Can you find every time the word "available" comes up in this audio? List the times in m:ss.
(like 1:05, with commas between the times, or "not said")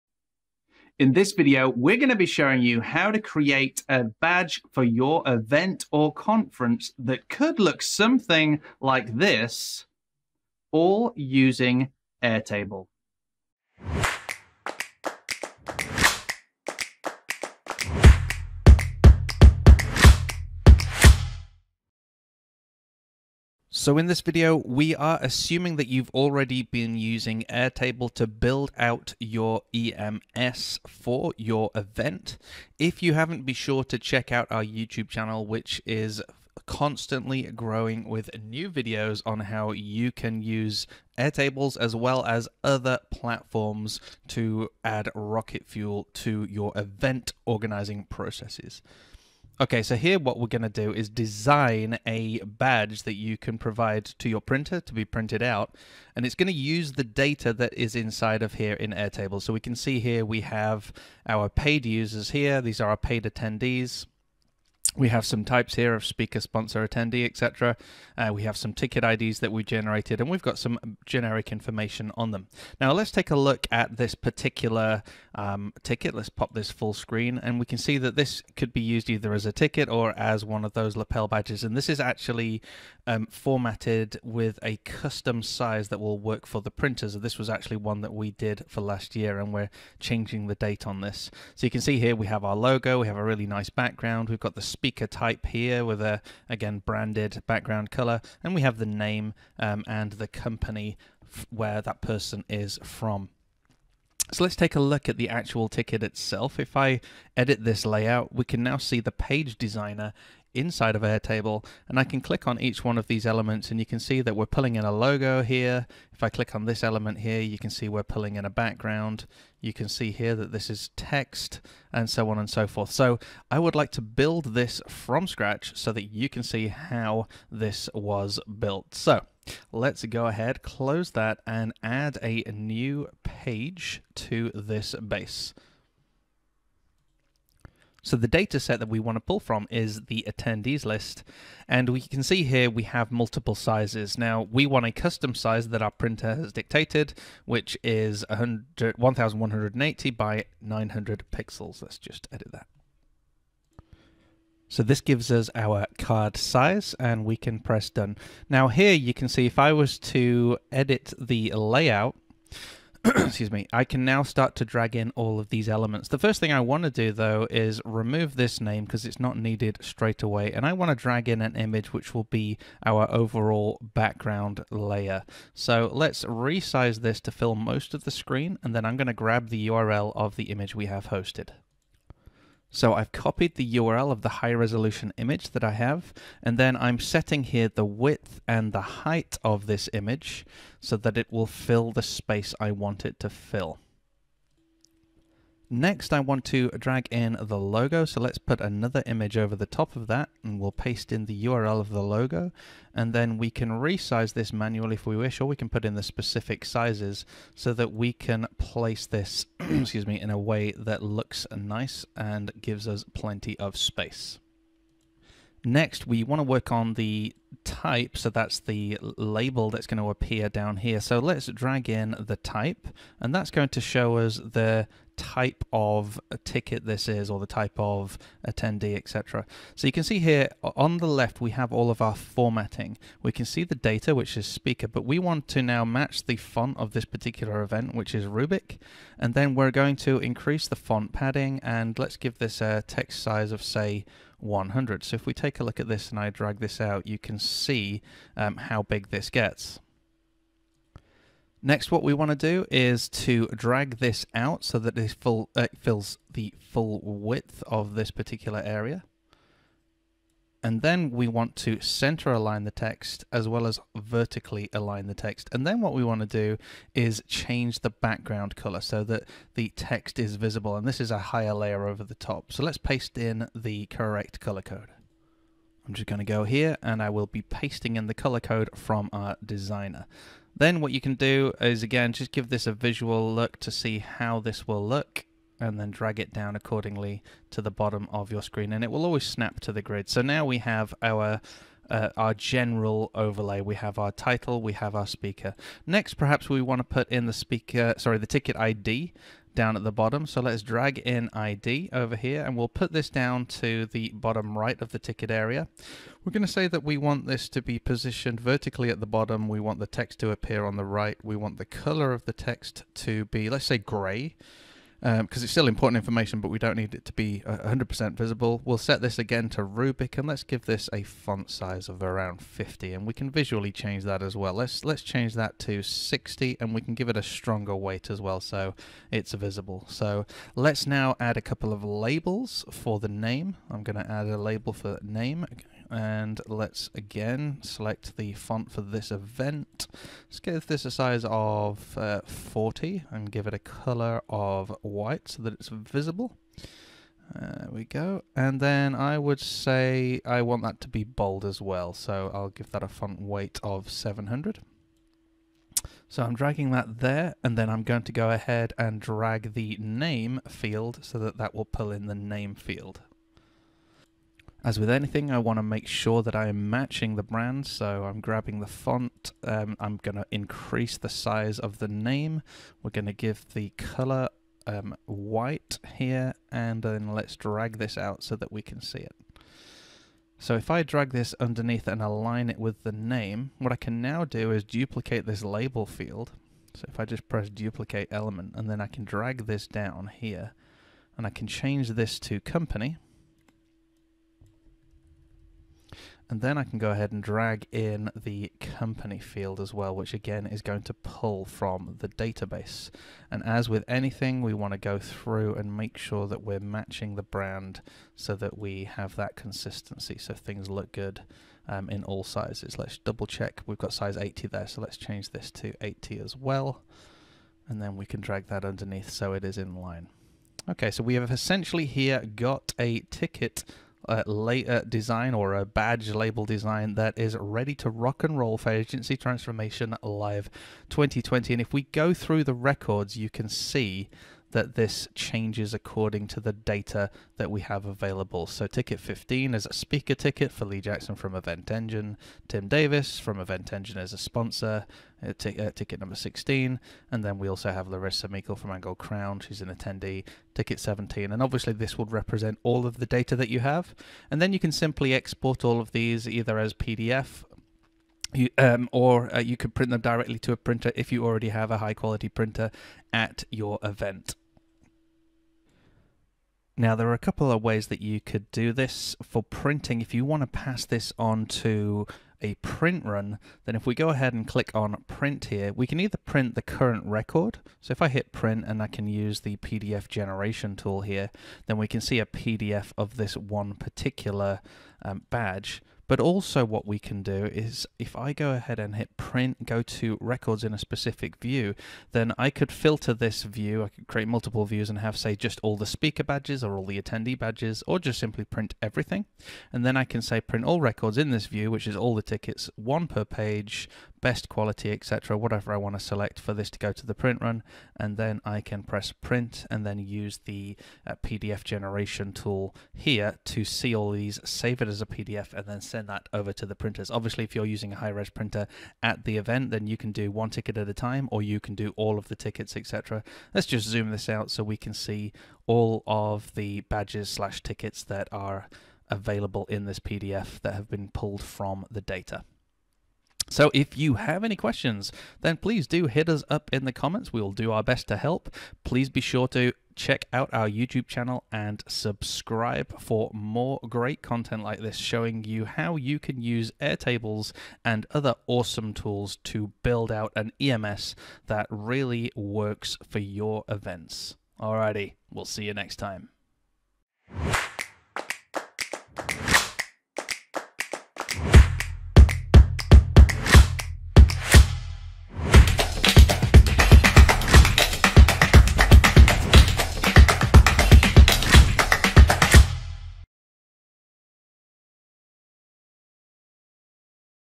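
7:17, 8:49.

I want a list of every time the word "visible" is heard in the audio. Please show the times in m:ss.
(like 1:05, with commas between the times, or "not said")
4:30, 5:18, 5:29, 5:45.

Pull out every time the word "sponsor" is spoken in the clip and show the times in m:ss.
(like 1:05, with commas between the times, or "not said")
1:06, 7:24.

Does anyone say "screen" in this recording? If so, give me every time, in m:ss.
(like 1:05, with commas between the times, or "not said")
1:16, 2:58, 4:48.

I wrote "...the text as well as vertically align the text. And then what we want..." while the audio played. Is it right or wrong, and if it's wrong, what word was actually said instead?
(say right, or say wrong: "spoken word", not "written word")
right.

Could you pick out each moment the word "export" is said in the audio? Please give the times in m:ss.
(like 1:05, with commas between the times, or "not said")
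7:35.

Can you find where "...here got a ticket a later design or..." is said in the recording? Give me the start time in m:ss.
7:01.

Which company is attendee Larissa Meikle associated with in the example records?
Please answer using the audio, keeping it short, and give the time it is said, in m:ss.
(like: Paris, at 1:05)
Angle Crown, at 7:28.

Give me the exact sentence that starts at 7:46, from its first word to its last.
Now, there are a couple of ways that you could do this for printing.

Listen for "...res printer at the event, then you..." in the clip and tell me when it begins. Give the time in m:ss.
8:38.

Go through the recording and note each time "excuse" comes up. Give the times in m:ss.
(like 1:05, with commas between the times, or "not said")
2:43, 3:29.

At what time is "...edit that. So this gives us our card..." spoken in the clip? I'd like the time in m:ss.
2:32.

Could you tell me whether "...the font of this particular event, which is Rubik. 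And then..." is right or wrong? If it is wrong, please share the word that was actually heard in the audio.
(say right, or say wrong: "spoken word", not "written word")
right.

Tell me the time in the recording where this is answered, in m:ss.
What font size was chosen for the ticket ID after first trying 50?
5:25.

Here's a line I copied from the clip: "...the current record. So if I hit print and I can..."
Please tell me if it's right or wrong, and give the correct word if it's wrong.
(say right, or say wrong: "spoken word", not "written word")
right.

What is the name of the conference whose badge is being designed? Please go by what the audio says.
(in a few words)
Agency Transformation Live 2020.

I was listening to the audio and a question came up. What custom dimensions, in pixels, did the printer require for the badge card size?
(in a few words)
1180 by 900.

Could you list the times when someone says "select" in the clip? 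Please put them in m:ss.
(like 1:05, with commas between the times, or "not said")
5:37, 8:25.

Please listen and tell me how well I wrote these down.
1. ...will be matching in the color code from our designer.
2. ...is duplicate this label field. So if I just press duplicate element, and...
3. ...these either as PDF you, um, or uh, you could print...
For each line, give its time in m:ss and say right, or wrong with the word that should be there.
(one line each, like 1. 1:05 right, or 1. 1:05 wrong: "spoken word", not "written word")
1. 4:37 wrong: "pasting", not "matching"
2. 6:24 right
3. 7:35 right.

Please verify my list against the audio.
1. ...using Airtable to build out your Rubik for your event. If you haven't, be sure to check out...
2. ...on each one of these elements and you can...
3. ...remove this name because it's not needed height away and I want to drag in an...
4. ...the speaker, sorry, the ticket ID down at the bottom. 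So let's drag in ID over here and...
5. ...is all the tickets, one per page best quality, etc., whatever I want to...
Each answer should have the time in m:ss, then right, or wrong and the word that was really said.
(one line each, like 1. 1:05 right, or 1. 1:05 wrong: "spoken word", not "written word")
1. 0:26 wrong: "EMS", not "Rubik"
2. 1:52 right
3. 2:47 wrong: "straight", not "height"
4. 4:57 right
5. 8:21 right.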